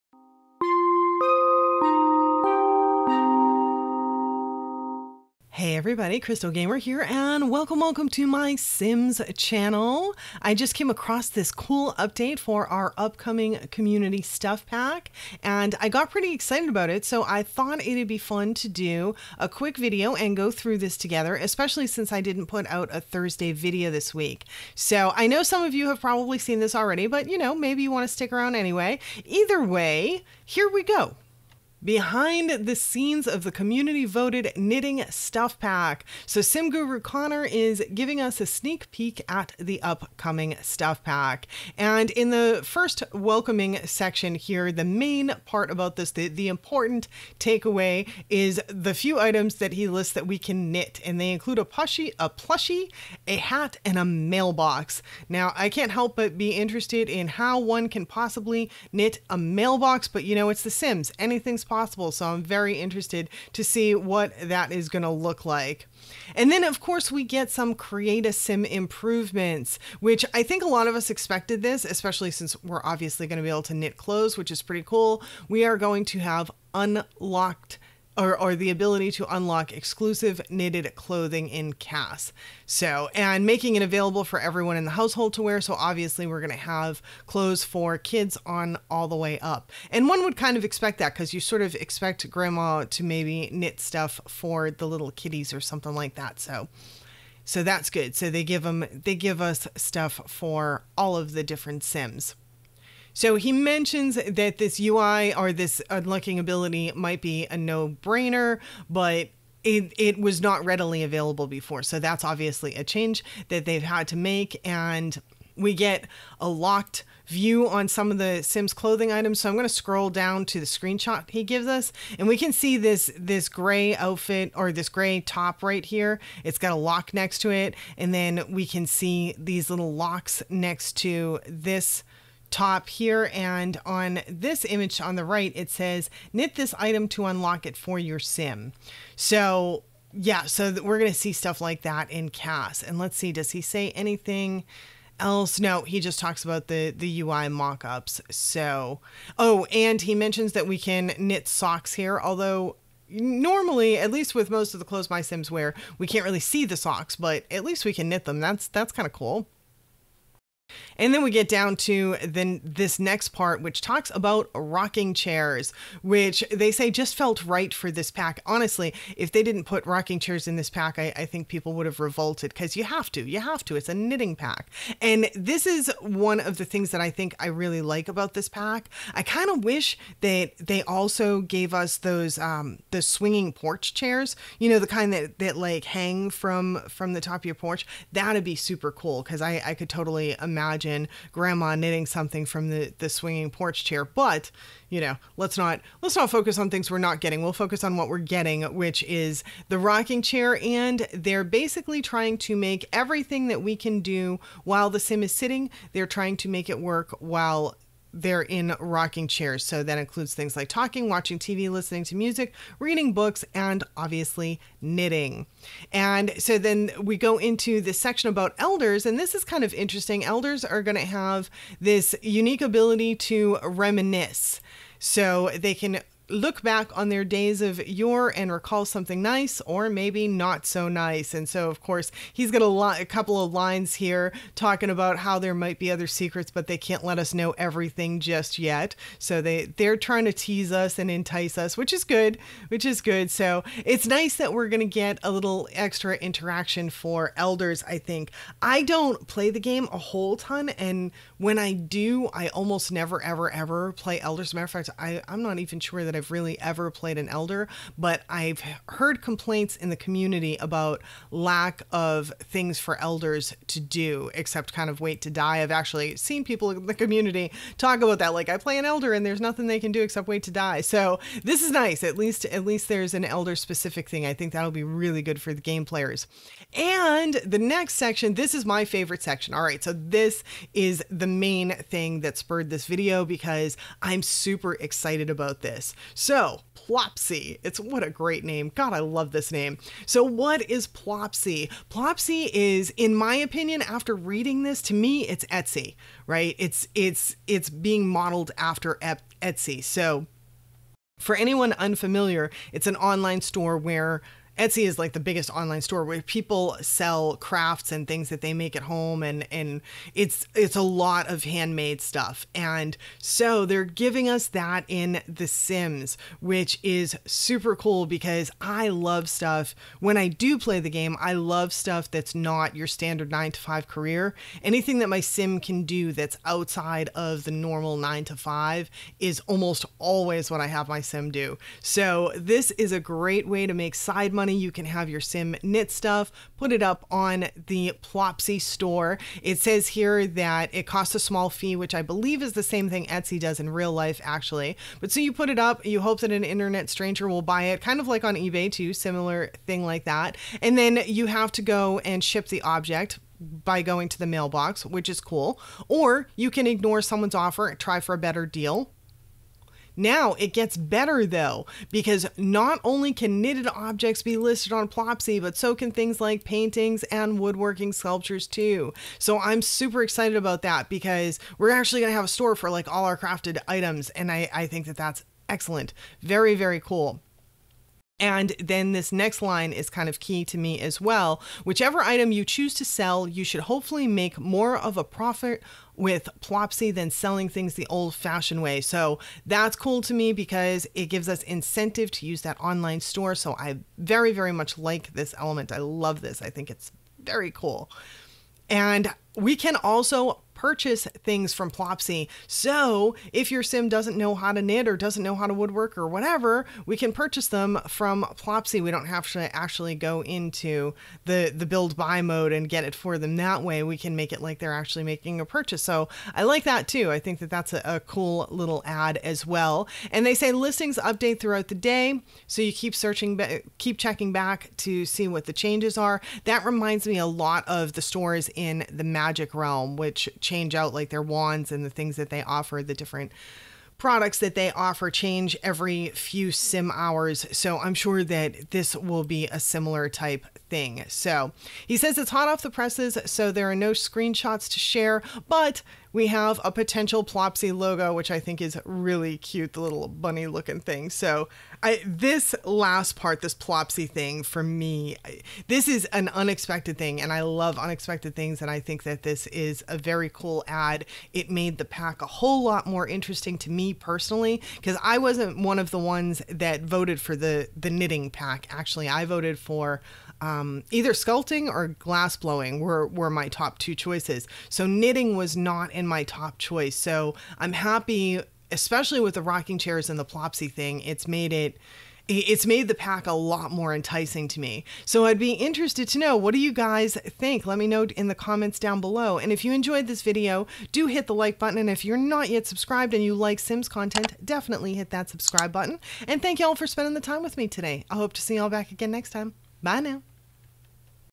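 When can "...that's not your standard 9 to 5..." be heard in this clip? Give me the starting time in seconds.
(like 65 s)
322 s.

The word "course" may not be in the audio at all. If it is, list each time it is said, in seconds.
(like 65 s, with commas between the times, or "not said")
66 s, 231 s.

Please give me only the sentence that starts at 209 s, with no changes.
So that includes things like talking, watching TV, listening to music, reading books, and obviously knitting.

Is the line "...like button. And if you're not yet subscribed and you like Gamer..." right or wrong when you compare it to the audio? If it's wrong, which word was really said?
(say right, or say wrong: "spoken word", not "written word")
wrong: "Sims", not "Gamer".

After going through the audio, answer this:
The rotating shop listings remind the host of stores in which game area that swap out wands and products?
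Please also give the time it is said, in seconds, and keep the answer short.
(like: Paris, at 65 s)
The Magic Realm, at 428 s.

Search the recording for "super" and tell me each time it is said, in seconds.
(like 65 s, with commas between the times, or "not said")
188 s, 284 s, 317 s, 369 s.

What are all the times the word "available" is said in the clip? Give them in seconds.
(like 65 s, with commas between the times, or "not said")
83 s, 111 s.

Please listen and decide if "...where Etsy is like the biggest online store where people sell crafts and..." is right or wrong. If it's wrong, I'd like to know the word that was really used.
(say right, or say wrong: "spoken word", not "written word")
right.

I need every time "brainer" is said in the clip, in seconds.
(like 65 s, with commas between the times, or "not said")
108 s.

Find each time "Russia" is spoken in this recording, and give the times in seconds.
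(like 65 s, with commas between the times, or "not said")
not said.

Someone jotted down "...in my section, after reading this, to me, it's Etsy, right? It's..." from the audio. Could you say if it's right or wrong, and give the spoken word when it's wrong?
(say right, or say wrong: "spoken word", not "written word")
wrong: "opinion", not "section".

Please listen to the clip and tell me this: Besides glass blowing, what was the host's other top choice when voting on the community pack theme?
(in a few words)
Sculpting.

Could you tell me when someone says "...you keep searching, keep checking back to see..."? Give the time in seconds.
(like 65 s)
422 s.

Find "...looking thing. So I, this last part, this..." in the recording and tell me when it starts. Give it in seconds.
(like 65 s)
450 s.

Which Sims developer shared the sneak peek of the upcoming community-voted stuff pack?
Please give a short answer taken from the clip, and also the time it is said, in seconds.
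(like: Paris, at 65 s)
Sim Guru Connor, at 36 s.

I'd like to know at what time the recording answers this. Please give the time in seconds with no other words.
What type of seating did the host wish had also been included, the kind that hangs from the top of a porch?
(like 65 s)
183 s.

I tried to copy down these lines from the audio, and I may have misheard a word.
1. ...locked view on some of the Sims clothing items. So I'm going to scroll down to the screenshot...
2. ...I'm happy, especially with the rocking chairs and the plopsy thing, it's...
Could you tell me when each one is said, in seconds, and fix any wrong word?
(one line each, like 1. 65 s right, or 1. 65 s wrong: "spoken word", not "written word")
1. 116 s right
2. 477 s right.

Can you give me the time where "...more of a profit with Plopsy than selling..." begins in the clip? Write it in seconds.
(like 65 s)
384 s.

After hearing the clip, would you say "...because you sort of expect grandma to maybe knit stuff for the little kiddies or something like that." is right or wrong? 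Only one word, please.
right.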